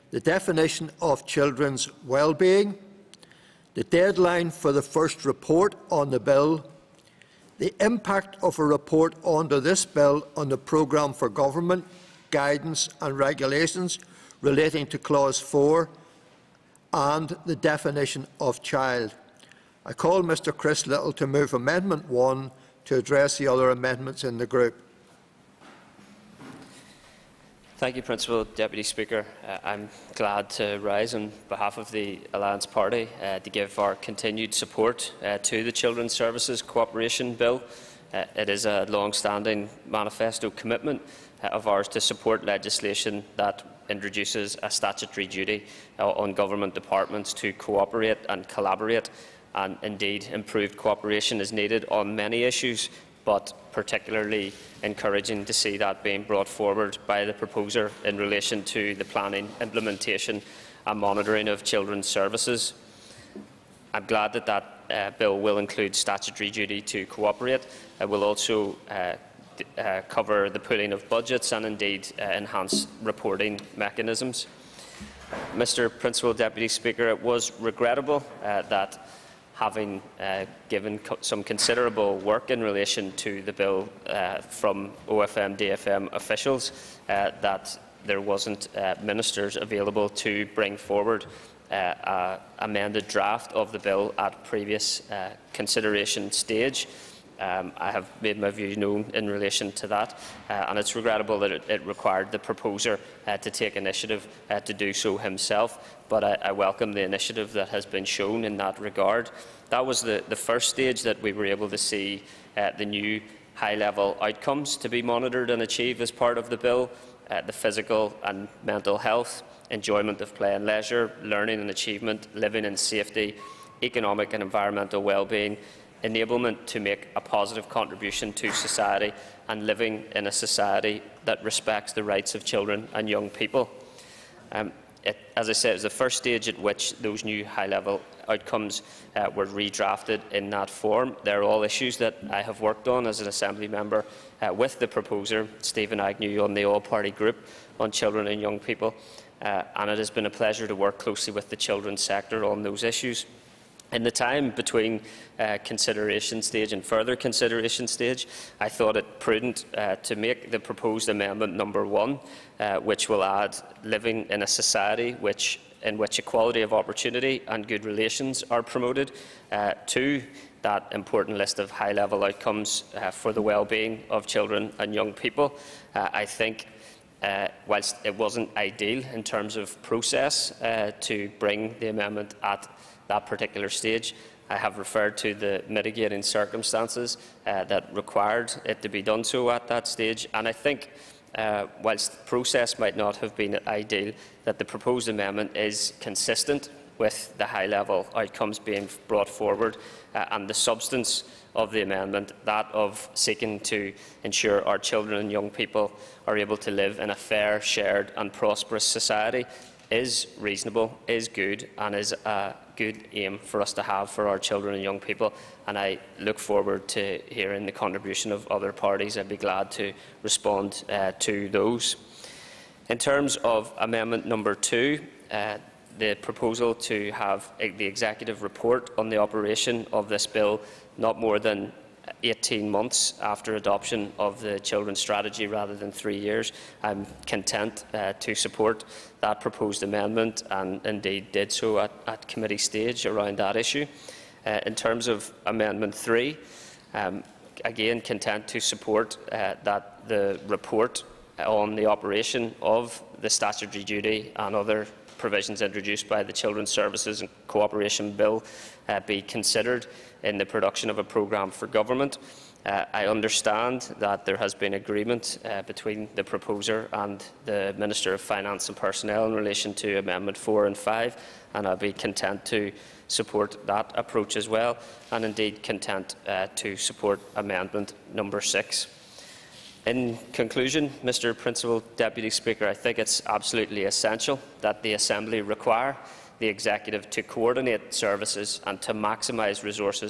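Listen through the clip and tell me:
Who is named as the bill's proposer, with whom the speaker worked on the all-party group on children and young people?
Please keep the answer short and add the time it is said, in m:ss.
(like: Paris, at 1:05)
Stephen Agnew, at 2:25.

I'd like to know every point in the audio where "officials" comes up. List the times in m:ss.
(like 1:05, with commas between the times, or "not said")
1:26.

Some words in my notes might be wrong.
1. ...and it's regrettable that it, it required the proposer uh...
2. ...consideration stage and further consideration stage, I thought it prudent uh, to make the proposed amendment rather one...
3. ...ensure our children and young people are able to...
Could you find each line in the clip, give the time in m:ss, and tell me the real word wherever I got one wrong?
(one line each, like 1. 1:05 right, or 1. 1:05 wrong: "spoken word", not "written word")
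1. 1:40 right
2. 2:35 wrong: "number", not "rather"
3. 3:24 right.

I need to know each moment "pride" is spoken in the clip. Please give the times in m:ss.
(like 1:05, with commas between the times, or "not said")
not said.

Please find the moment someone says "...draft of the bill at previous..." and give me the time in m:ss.
1:33.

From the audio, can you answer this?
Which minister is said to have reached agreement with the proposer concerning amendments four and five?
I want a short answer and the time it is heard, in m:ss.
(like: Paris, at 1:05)
Minister of Finance and Personnel, at 4:27.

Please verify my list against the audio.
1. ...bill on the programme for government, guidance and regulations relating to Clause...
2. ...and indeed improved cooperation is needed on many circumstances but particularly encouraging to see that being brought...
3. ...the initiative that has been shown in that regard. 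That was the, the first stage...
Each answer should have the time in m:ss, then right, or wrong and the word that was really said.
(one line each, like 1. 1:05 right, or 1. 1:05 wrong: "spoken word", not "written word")
1. 0:09 right
2. 0:49 wrong: "issues", not "circumstances"
3. 1:46 right.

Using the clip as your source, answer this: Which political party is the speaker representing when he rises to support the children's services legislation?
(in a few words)
Alliance Party.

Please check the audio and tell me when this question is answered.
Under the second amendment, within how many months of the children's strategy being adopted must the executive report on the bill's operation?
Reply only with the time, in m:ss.
3:52.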